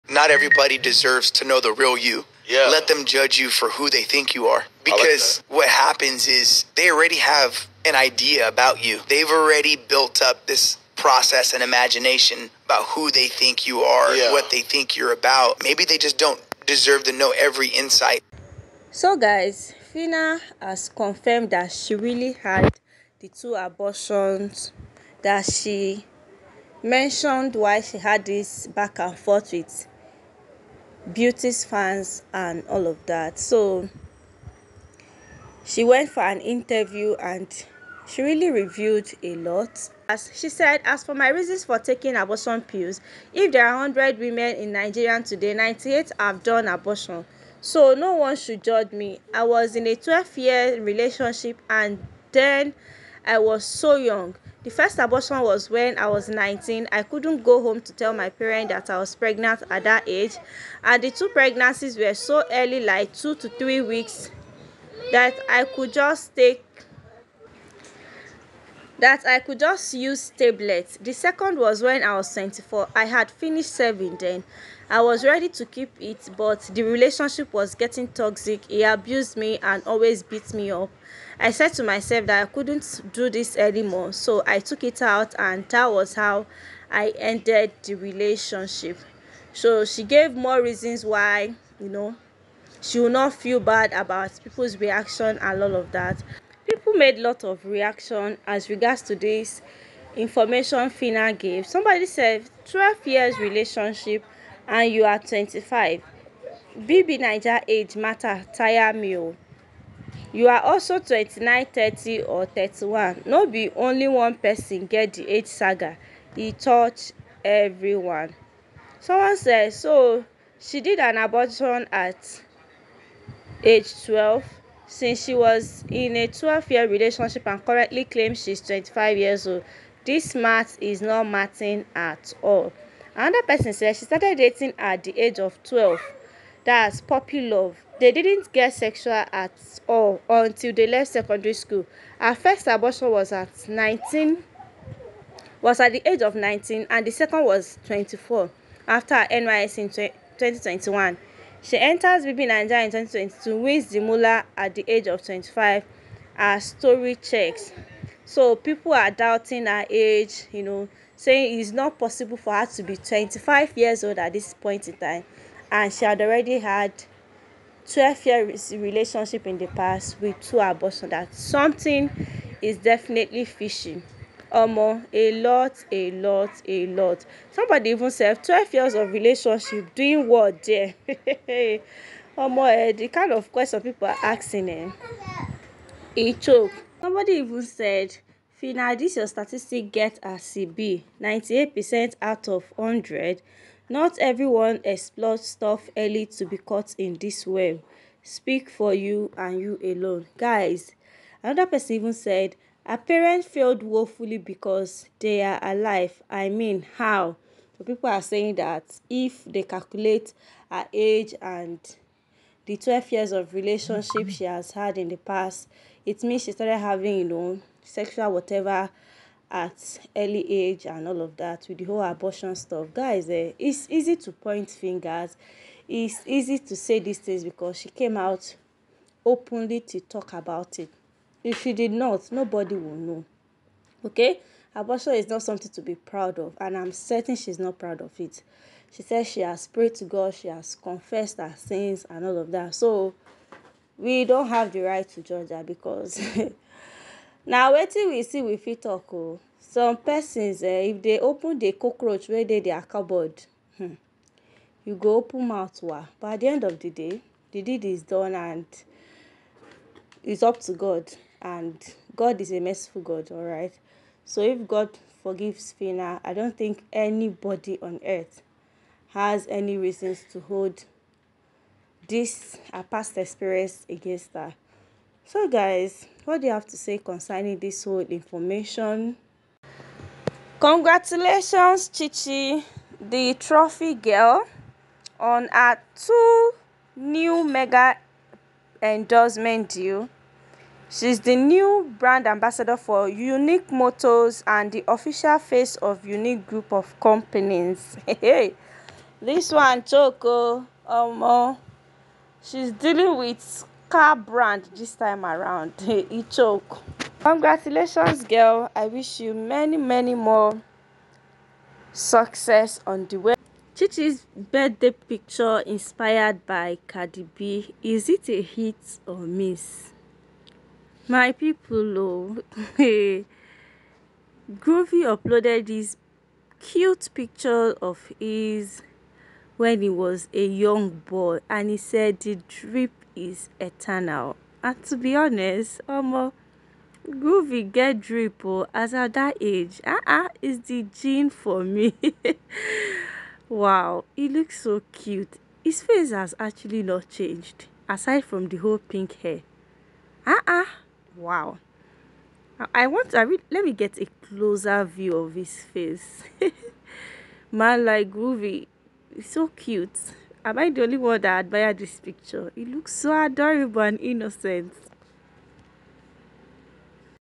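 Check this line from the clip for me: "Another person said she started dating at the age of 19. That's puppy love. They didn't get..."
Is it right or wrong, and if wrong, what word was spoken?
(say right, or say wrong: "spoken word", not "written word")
wrong: "12", not "19".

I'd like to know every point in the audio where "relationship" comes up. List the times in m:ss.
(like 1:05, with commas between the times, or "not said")
0:50, 1:16, 1:27, 1:43, 2:06, 2:48, 2:59, 3:33.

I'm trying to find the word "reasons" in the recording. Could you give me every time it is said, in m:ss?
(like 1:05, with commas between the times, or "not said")
0:41, 1:30, 4:29.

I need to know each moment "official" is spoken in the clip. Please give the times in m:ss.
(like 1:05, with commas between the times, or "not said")
4:54.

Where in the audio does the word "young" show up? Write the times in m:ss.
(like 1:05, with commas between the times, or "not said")
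0:53, 5:30.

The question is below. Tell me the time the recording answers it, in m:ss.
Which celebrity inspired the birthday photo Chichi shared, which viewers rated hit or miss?
5:16.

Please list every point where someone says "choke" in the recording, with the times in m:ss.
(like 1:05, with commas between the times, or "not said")
3:06, 5:06.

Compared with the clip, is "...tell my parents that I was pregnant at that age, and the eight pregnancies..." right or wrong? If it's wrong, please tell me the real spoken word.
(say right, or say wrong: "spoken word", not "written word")
wrong: "two", not "eight".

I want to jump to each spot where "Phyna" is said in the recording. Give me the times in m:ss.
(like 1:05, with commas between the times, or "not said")
0:19, 4:25.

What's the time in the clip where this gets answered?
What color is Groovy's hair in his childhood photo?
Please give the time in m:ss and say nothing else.
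5:48.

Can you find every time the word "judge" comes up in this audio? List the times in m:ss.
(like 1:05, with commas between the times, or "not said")
0:03, 0:48, 4:05.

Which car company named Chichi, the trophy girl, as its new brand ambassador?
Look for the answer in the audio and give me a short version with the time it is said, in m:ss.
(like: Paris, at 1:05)
Unique Motors, at 4:53.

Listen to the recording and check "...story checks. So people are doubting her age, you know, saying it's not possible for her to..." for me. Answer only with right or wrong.
right.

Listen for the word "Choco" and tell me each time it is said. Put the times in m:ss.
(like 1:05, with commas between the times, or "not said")
4:59.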